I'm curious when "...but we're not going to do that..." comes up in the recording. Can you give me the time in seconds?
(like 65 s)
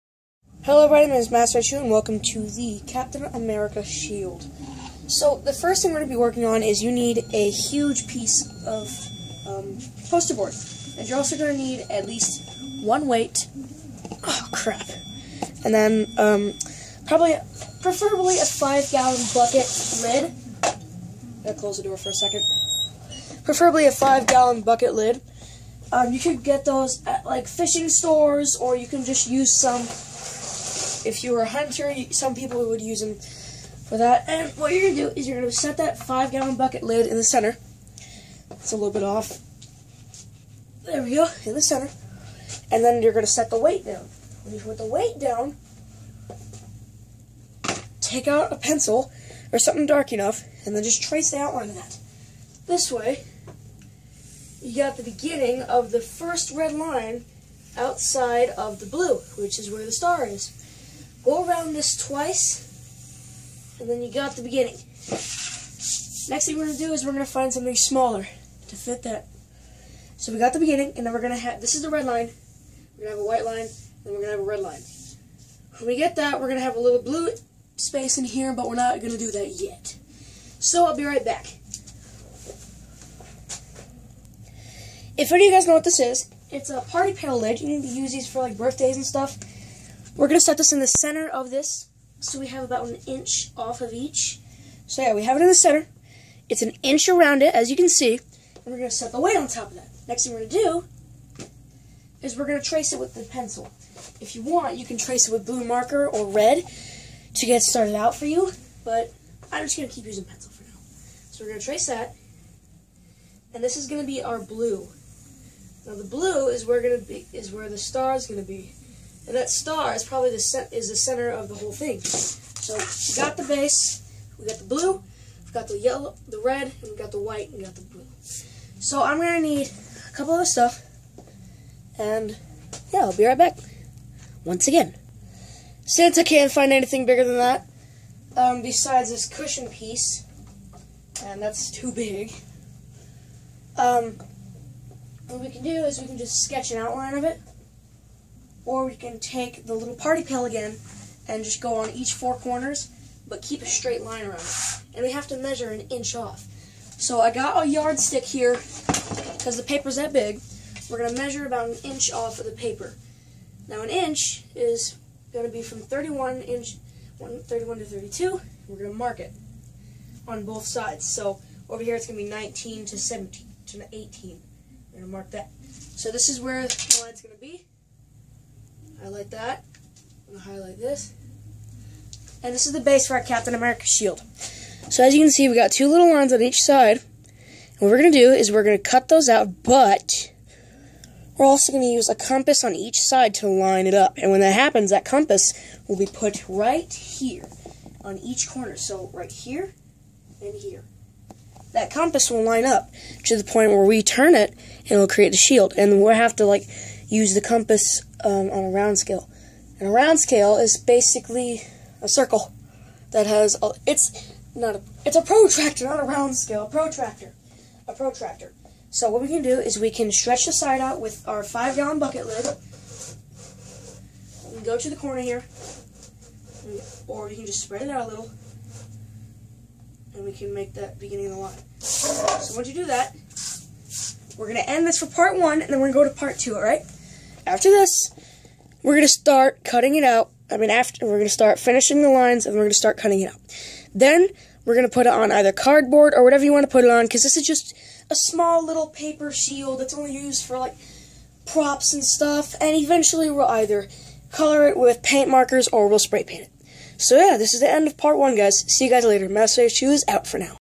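78 s.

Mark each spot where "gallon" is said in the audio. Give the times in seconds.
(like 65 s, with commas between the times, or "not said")
18 s, 23 s, 36 s, 221 s.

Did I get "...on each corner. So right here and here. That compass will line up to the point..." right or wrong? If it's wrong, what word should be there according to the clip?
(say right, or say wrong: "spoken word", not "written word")
right.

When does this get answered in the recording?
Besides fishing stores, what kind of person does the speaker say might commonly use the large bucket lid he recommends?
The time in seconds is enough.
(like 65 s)
31 s.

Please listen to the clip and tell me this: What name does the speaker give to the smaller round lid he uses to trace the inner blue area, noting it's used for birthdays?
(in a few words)
party pail lid.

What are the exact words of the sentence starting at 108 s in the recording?
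But I'm just going to keep using pencil for now.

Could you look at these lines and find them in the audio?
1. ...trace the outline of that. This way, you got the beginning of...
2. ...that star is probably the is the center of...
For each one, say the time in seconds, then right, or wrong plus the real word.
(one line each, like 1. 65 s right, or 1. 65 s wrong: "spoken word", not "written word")
1. 51 s right
2. 119 s right.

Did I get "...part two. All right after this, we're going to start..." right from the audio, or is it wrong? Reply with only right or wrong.
right.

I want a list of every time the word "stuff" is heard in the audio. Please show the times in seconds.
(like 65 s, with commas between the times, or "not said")
89 s, 130 s, 252 s.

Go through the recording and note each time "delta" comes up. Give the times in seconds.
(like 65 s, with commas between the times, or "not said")
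not said.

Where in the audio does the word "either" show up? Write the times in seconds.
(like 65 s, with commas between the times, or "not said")
245 s, 253 s.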